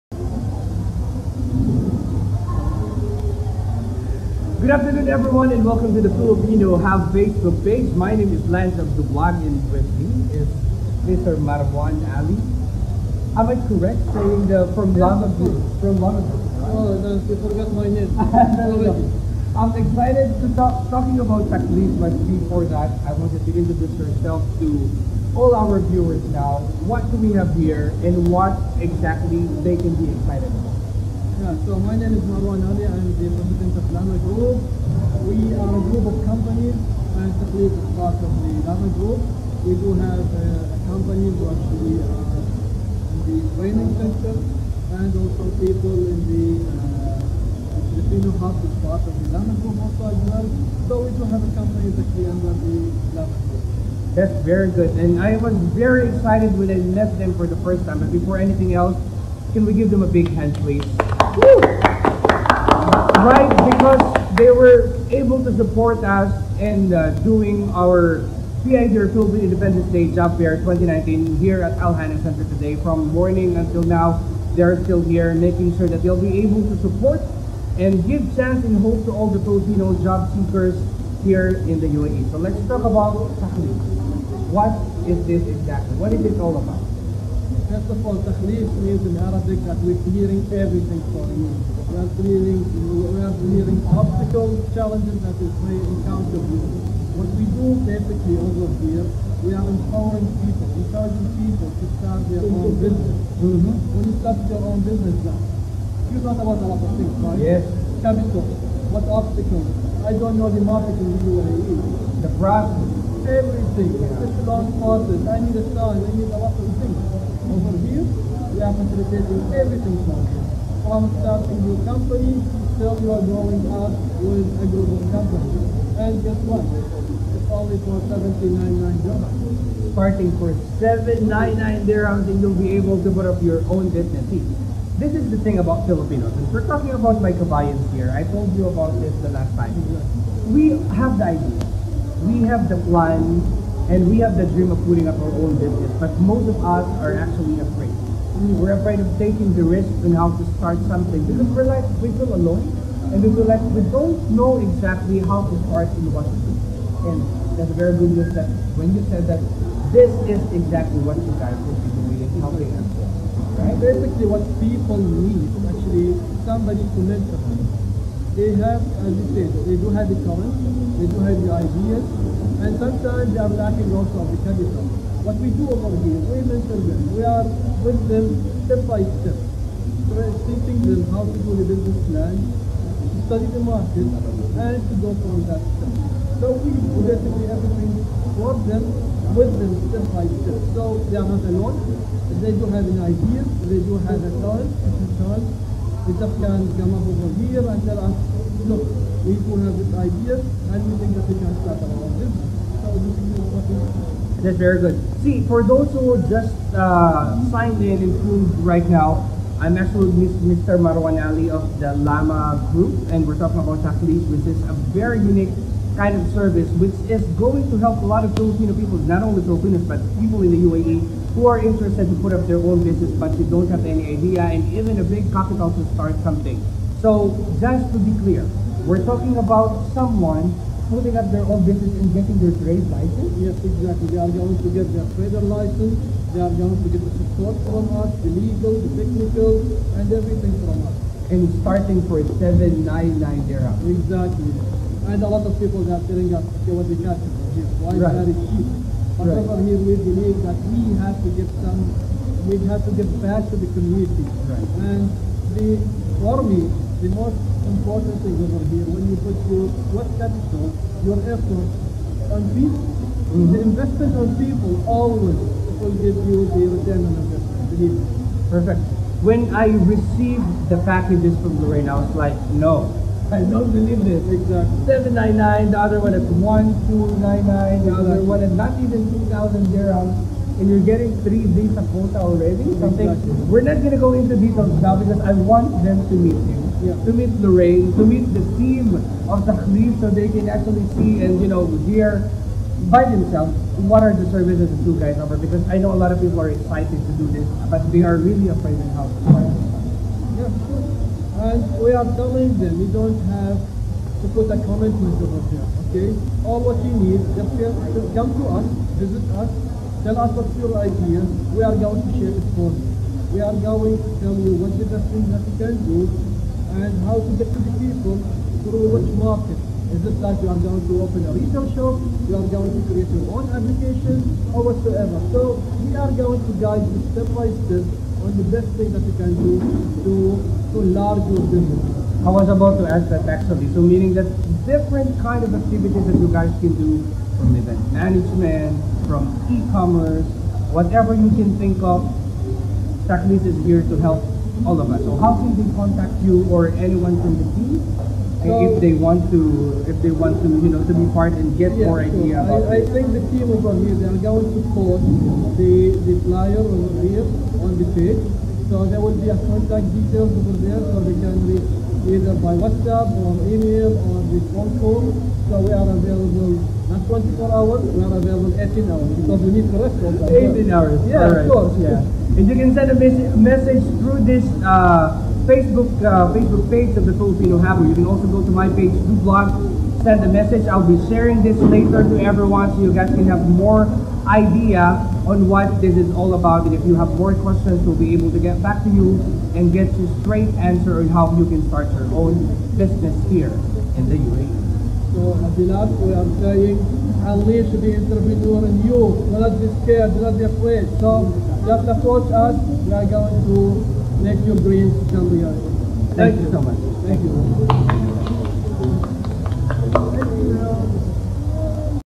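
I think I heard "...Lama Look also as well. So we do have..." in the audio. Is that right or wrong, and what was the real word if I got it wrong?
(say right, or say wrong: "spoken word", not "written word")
wrong: "Group", not "Look".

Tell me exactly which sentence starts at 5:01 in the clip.
And we are telling them you don't have to put a comment the there, okay?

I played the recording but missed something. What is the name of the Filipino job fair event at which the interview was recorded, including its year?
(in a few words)
Philippine Independence Day Job Fair 2019.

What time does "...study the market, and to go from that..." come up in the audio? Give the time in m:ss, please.
3:03.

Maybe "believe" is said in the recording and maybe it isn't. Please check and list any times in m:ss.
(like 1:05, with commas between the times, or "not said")
4:10, 4:33.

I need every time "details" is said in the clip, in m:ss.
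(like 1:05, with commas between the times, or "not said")
4:44, 5:59.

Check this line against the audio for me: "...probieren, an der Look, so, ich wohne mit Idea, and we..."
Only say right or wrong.
right.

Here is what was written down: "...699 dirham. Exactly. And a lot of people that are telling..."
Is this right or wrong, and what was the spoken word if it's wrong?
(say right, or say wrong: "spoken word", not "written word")
wrong: "799", not "699".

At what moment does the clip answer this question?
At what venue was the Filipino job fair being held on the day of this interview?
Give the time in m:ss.
1:11.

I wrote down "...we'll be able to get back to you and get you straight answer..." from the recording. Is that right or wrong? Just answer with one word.
right.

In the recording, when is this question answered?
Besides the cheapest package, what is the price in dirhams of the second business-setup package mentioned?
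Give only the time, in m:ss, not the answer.
4:36.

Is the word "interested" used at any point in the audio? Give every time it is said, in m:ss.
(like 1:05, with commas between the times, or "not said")
3:41.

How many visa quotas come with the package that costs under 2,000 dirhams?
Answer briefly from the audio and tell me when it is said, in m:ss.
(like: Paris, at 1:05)
3, at 4:41.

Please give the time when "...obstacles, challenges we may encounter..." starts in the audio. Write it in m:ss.
1:33.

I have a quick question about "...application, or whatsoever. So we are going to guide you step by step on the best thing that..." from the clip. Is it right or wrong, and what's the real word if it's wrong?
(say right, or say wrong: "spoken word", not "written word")
right.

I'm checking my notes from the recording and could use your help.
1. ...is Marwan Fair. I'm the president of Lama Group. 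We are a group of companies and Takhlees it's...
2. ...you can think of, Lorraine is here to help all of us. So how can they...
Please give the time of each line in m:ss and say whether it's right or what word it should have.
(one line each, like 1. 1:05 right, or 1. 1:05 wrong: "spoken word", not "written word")
1. 0:32 wrong: "Ali", not "Fair"
2. 5:41 wrong: "Takhlees", not "Lorraine".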